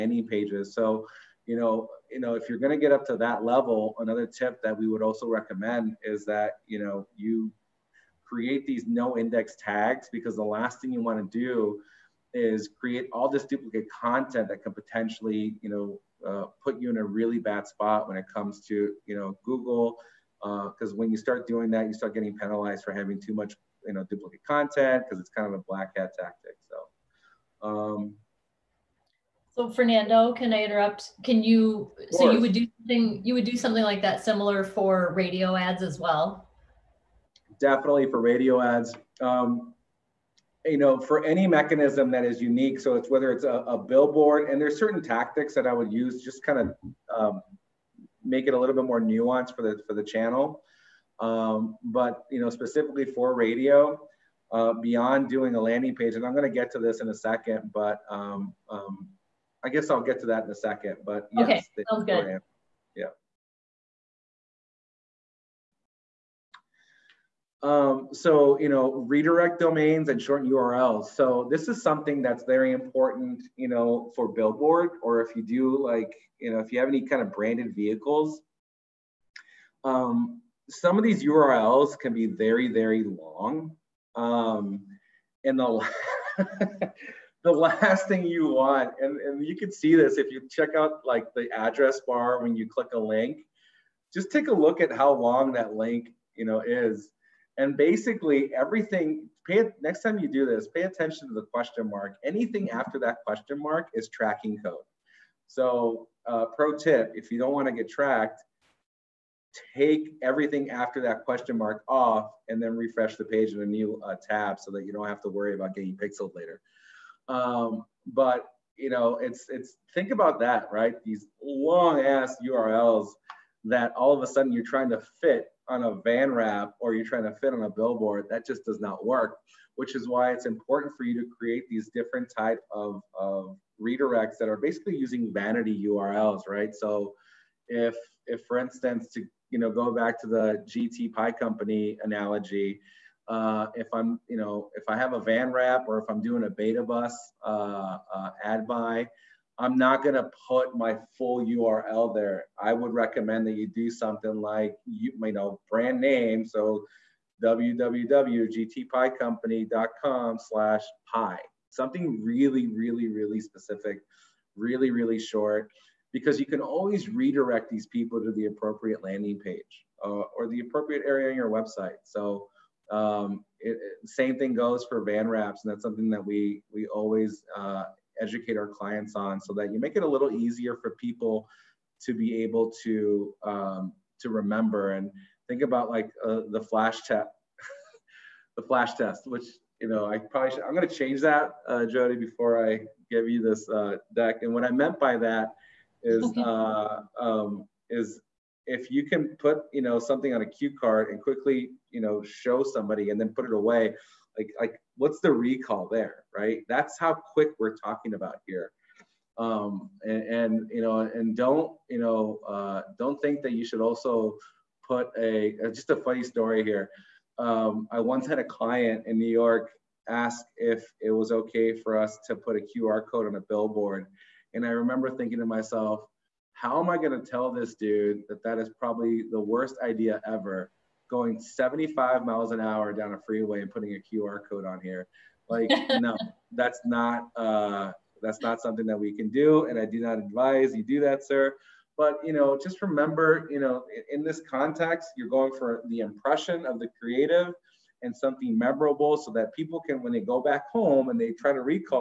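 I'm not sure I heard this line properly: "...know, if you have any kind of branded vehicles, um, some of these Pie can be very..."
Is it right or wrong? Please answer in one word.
wrong.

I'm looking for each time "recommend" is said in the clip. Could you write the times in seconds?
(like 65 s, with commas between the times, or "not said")
5 s, 152 s.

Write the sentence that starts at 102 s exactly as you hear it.
Anything after that question mark is tracking code.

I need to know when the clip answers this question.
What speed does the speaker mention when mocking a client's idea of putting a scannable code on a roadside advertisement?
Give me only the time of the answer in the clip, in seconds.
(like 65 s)
231 s.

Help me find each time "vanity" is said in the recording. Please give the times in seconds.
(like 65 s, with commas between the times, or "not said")
135 s.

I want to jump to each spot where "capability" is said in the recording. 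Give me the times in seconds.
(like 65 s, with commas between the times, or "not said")
not said.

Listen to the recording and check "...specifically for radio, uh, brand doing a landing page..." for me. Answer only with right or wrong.
wrong.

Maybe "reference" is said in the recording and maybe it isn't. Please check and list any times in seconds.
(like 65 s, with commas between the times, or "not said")
not said.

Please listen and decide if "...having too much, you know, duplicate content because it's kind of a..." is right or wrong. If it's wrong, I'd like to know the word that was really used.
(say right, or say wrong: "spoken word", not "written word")
right.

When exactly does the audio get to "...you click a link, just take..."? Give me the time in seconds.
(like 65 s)
92 s.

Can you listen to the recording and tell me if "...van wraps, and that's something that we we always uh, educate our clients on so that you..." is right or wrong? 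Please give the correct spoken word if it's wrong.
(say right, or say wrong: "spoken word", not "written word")
right.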